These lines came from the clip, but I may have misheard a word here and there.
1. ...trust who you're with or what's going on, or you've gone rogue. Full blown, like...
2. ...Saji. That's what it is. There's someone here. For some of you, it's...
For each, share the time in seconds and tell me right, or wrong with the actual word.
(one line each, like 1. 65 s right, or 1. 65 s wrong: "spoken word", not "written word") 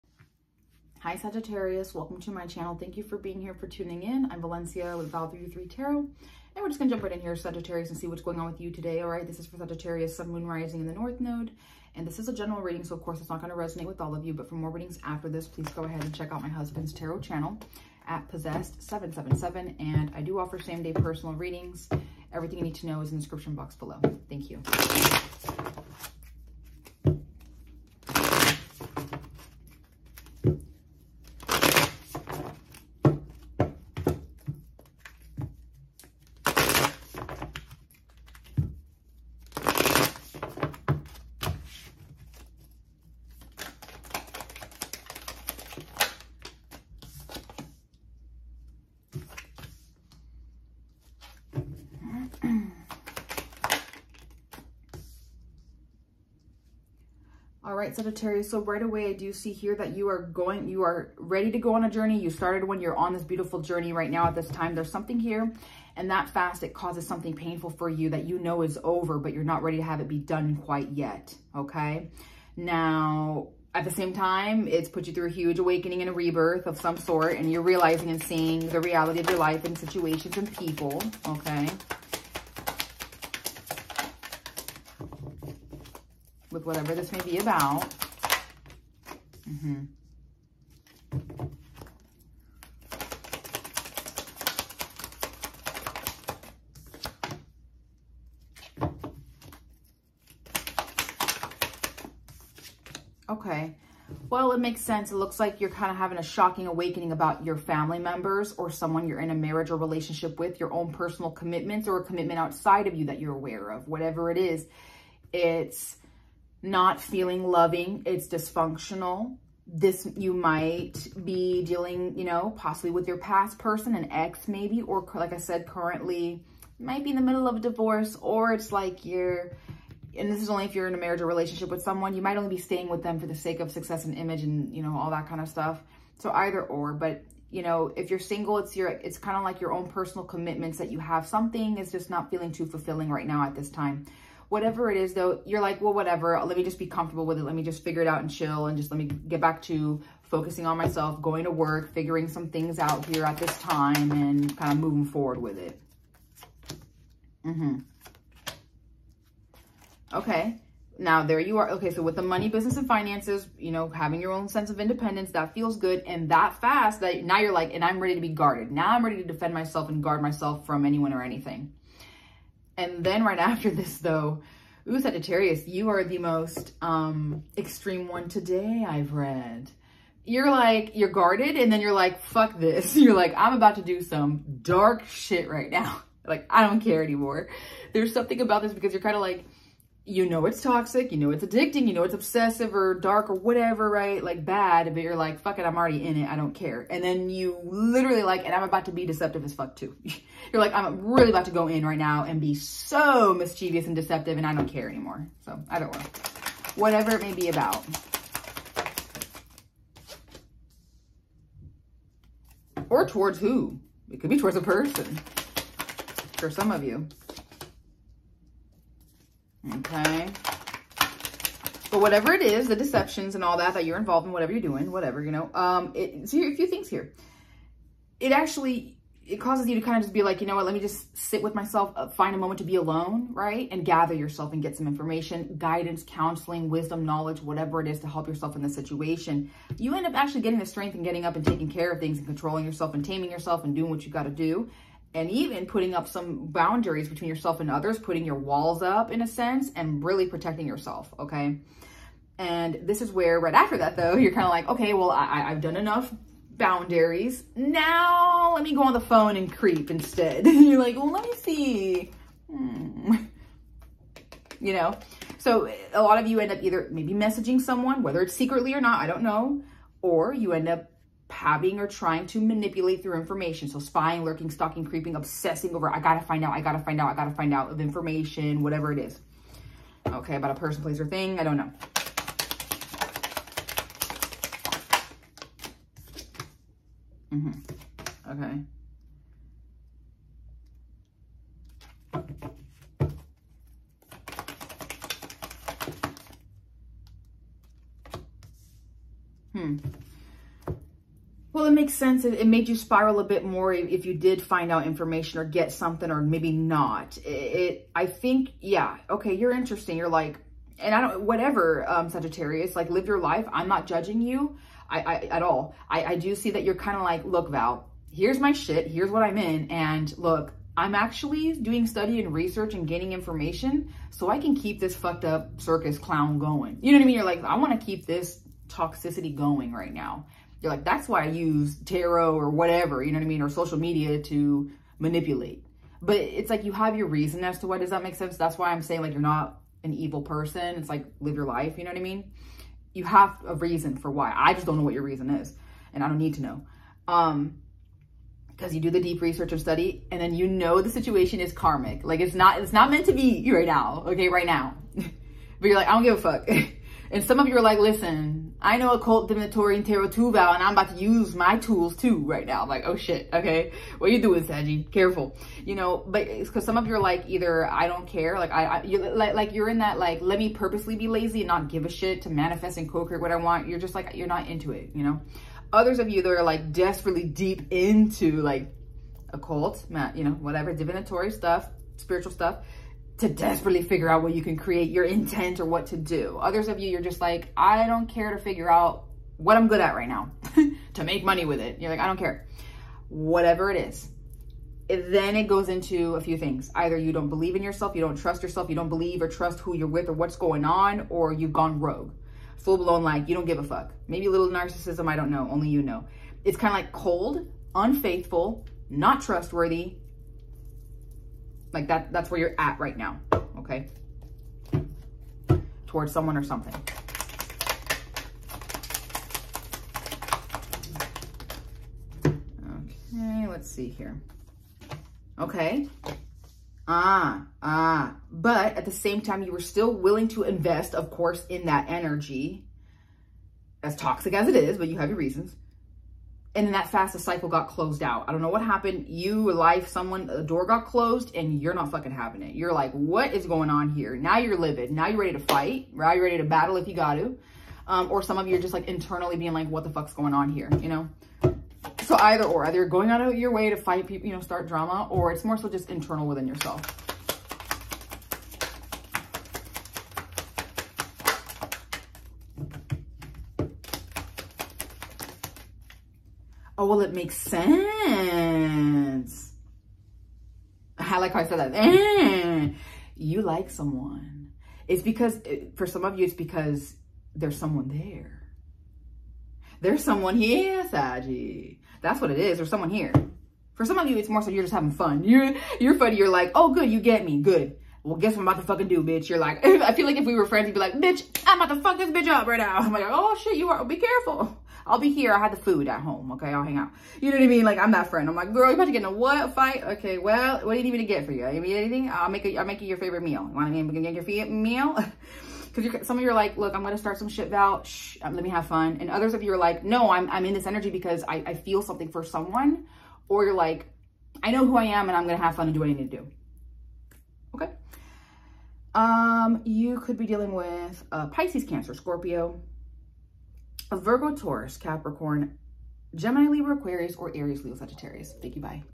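1. 399 s right
2. 480 s right.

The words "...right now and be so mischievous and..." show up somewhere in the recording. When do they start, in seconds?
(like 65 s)
201 s.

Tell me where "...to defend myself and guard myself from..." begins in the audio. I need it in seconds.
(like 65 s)
169 s.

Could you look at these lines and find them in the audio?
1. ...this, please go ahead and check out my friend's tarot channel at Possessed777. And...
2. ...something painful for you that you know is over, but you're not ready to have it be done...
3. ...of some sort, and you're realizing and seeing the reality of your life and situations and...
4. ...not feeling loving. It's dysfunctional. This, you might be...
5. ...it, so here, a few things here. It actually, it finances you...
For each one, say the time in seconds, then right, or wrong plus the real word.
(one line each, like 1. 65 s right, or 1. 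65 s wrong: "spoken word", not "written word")
1. 15 s wrong: "husband", not "friend"
2. 67 s right
3. 76 s right
4. 116 s right
5. 225 s wrong: "causes", not "finances".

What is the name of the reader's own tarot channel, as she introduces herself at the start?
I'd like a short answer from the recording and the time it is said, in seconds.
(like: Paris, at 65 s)
val Three Tarot, at 5 s.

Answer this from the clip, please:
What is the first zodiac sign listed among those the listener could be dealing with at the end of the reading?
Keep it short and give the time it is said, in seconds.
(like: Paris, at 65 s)
Pisces, at 521 s.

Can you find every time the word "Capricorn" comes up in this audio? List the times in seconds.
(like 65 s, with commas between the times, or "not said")
524 s.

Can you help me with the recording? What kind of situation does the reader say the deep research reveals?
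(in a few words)
karmic.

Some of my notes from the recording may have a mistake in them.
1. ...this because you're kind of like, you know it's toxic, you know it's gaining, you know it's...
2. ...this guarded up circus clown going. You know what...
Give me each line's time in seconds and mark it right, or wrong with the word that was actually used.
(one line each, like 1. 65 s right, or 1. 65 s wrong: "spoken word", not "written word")
1. 188 s wrong: "addicting", not "gaining"
2. 324 s wrong: "fucked", not "guarded".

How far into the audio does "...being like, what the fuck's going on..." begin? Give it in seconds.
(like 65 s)
449 s.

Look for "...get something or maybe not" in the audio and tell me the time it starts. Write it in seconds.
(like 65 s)
305 s.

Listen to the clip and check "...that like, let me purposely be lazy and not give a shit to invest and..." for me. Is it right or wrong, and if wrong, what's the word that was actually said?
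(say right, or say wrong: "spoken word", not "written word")
wrong: "manifest", not "invest".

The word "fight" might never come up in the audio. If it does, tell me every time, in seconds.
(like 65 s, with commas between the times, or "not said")
445 s, 453 s, 499 s.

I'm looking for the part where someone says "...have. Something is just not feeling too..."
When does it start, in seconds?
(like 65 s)
140 s.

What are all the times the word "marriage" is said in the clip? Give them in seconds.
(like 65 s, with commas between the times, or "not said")
109 s, 130 s.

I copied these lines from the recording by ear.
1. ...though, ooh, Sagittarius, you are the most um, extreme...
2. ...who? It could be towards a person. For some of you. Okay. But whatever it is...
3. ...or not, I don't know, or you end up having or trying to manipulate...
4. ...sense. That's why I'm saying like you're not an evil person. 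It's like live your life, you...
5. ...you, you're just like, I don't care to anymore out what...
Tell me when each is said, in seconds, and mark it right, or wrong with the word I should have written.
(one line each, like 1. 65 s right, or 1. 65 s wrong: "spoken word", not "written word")
1. 173 s right
2. 213 s right
3. 268 s right
4. 338 s right
5. 386 s wrong: "figure", not "anymore".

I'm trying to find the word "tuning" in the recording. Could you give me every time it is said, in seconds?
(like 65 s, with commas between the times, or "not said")
3 s.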